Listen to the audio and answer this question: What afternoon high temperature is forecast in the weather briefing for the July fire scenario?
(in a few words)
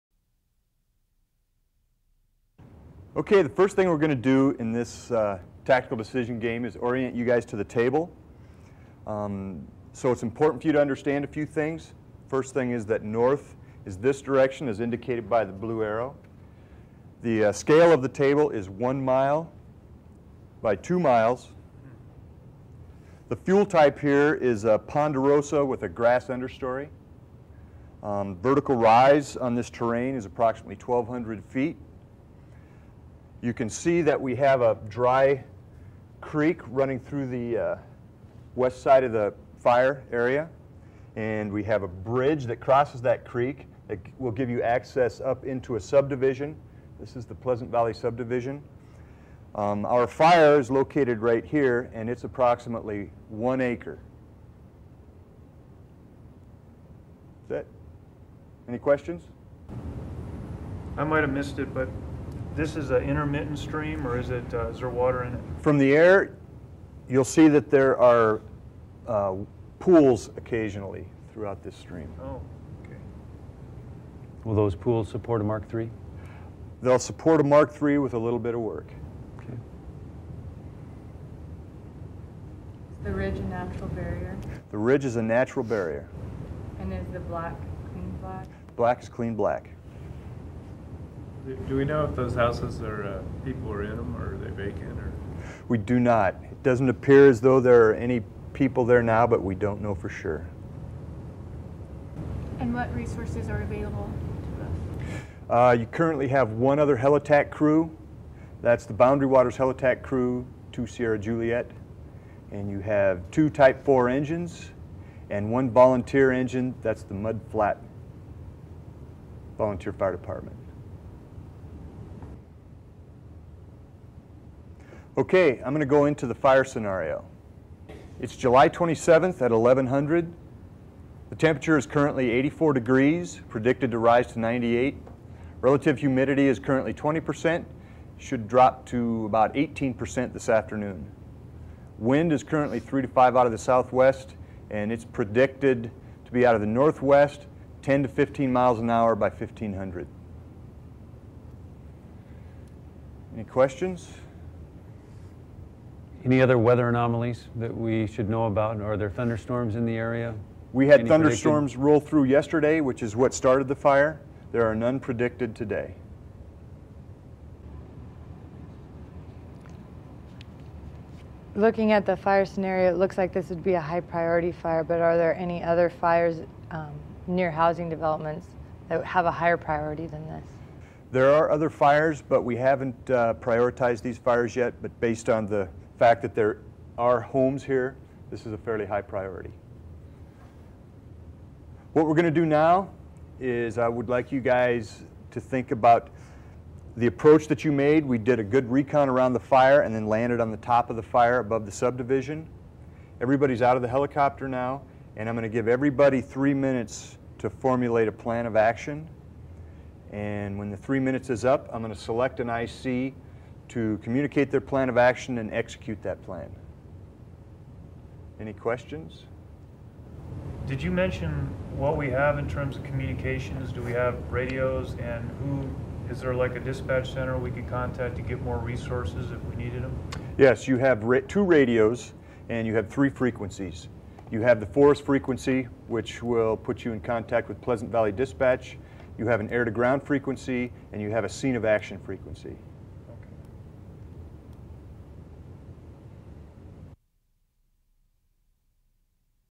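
98 degrees.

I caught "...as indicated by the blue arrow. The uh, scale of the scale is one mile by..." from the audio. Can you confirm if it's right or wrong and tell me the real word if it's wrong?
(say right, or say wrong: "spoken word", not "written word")
wrong: "table", not "scale".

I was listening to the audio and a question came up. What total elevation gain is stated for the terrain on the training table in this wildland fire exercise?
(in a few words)
1,200 feet.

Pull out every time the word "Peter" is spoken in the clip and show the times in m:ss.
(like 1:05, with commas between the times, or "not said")
not said.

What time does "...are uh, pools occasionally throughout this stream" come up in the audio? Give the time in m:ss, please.
1:07.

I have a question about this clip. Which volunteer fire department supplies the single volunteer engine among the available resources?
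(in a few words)
Mud Flat Volunteer Fire Department.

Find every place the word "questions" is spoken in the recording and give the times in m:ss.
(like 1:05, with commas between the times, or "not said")
0:58, 2:33, 3:38.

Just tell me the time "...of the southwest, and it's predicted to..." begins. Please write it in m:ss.
2:23.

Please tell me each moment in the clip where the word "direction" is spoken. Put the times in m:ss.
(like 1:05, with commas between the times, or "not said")
0:14.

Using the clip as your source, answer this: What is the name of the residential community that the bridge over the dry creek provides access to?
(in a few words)
Pleasant Valley subdivision.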